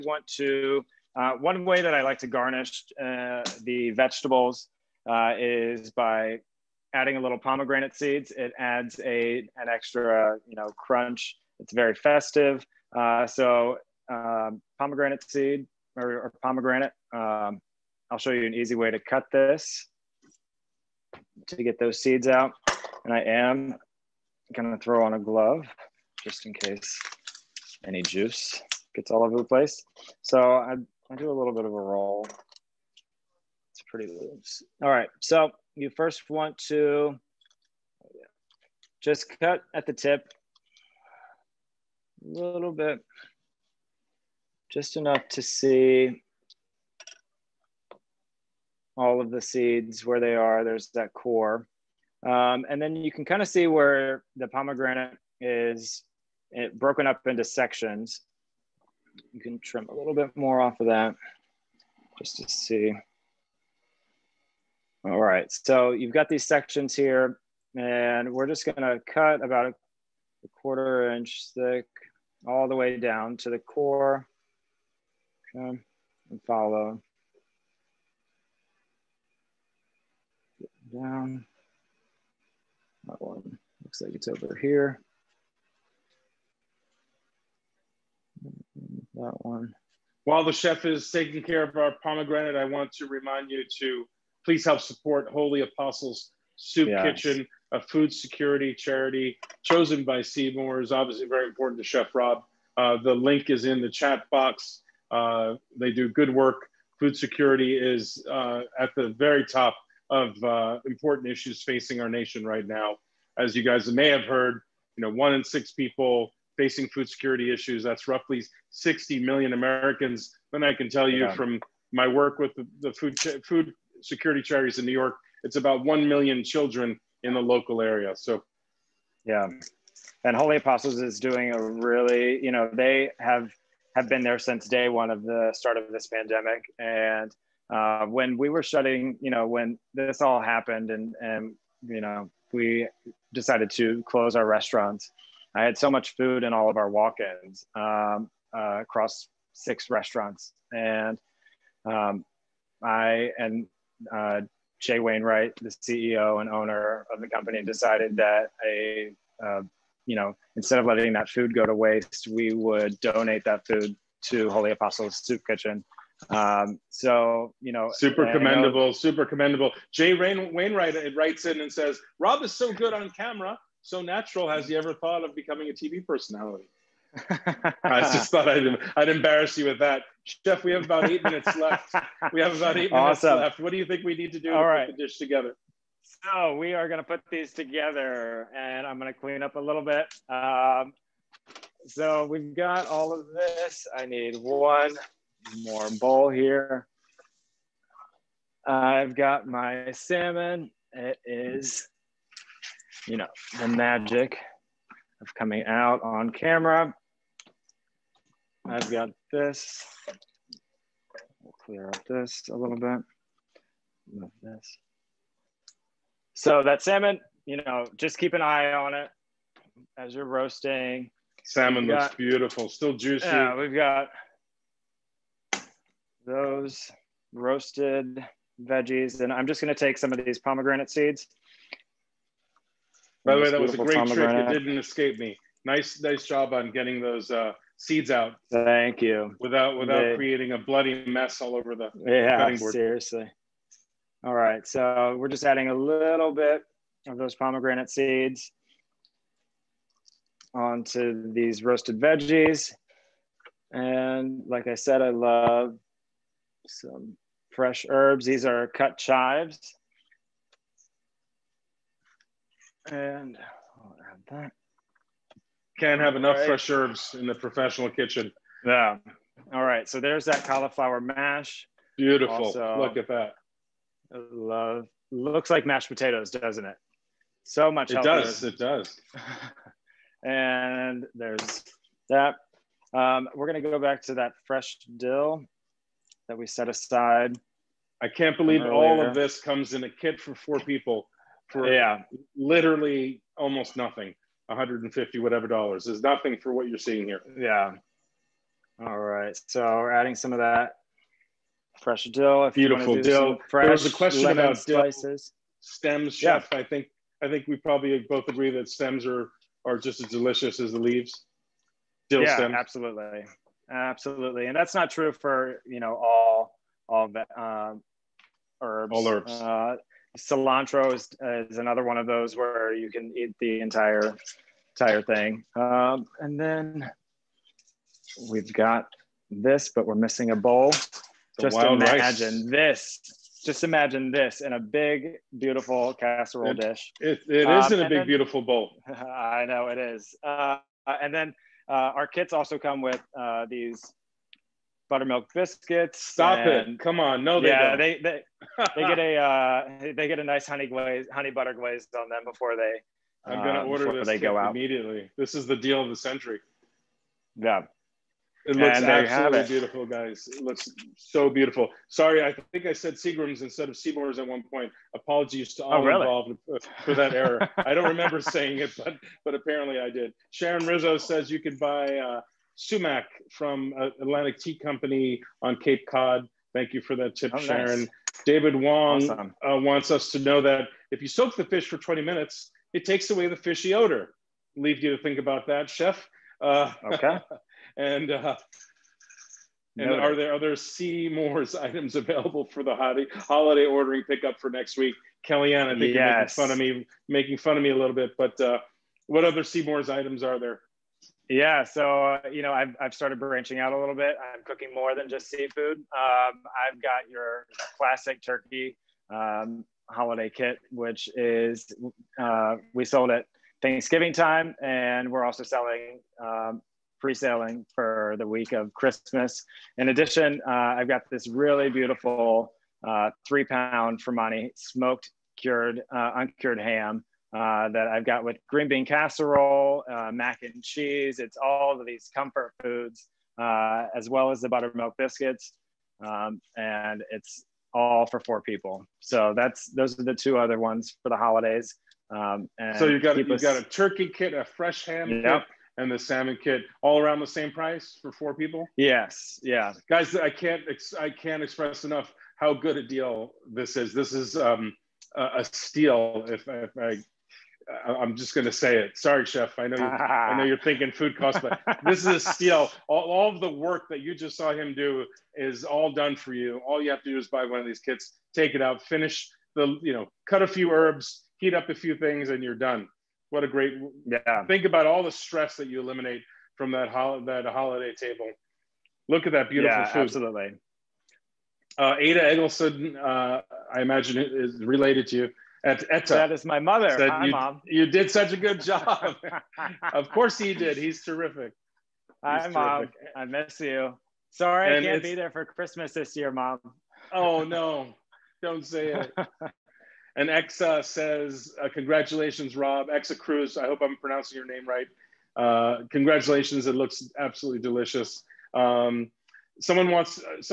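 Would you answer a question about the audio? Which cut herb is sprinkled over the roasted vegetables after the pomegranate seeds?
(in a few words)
chives.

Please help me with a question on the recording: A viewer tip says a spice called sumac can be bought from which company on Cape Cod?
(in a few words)
Atlantic Tea Company.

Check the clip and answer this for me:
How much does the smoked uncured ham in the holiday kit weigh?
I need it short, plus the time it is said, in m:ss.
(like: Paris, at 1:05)
3 pounds, at 7:03.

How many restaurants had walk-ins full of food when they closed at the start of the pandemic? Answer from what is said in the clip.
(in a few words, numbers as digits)
6.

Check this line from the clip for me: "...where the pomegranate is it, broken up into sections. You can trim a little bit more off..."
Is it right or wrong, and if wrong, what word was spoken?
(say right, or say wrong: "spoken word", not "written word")
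right.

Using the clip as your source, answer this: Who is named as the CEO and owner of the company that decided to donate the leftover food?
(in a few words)
Jay Wainwright.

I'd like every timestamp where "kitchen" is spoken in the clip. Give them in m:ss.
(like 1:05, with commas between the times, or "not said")
1:37, 2:45, 4:27.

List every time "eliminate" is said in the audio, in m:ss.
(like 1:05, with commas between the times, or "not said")
7:55.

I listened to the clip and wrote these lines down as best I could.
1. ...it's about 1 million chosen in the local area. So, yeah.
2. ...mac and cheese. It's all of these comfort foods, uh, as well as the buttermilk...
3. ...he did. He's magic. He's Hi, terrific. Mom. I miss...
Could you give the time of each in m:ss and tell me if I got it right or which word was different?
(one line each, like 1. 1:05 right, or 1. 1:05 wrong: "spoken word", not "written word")
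1. 2:05 wrong: "children", not "chosen"
2. 7:10 right
3. 8:10 wrong: "terrific", not "magic".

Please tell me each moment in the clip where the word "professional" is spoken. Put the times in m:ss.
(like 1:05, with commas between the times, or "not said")
4:27.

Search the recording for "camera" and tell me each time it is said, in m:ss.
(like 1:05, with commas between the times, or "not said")
2:53, 3:26.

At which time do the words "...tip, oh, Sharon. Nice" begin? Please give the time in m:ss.
6:17.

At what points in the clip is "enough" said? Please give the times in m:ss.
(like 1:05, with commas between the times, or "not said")
0:44, 4:26, 7:31.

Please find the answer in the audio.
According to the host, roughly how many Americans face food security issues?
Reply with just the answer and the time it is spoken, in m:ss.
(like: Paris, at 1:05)
60 million, at 1:58.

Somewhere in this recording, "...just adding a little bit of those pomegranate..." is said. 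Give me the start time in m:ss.
4:05.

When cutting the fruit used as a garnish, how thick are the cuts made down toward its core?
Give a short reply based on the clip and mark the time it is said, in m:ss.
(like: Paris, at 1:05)
a quarter inch, at 1:09.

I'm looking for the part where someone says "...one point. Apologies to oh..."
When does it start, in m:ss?
6:04.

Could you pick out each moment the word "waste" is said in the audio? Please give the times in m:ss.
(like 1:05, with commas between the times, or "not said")
2:41.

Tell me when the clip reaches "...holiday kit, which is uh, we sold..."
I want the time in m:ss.
6:49.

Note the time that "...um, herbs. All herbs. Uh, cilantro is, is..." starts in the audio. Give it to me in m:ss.
5:17.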